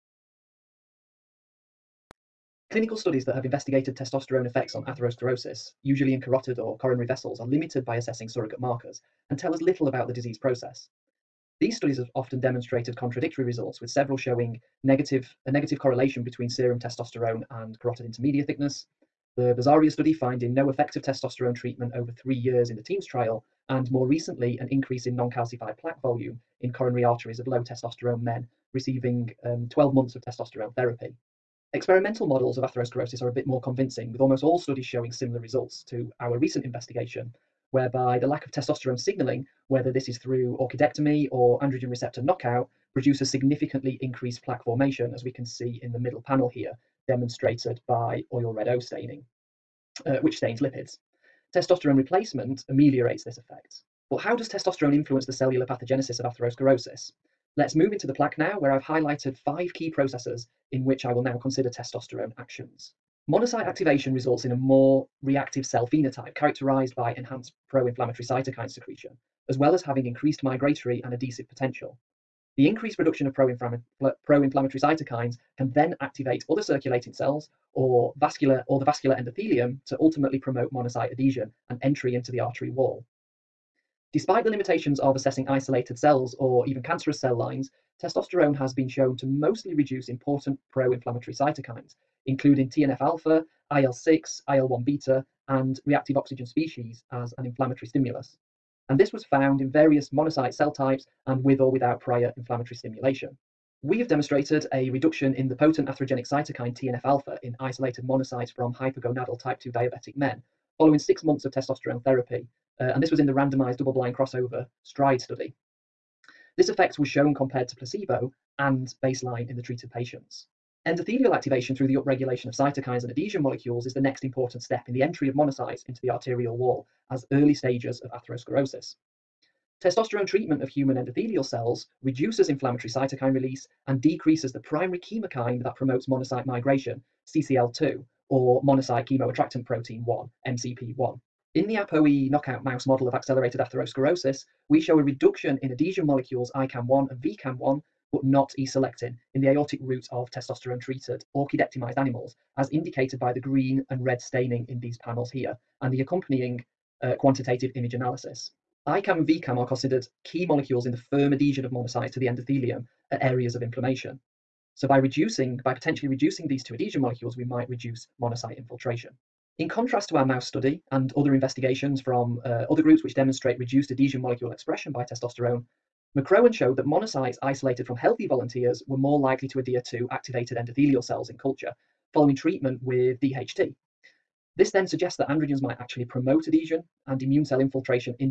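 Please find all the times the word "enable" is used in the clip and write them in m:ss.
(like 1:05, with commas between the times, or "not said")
not said.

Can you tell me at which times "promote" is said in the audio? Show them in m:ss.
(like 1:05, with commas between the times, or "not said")
1:20, 2:15, 3:06.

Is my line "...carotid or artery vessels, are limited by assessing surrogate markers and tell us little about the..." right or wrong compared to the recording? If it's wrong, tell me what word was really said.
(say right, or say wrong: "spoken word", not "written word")
wrong: "coronary", not "artery".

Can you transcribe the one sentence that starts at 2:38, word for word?
ICAM and VCAM are considered key molecules in the firm adhesion of monocytes to the endothelium at areas of inflammation.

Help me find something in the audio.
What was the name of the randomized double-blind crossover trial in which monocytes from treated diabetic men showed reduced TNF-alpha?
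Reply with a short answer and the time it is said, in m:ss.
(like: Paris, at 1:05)
STRIDE, at 1:54.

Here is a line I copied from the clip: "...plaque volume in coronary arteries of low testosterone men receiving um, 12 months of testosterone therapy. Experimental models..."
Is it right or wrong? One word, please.
right.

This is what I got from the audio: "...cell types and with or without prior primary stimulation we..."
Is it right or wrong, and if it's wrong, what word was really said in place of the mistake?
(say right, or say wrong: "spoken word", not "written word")
wrong: "inflammatory", not "primary".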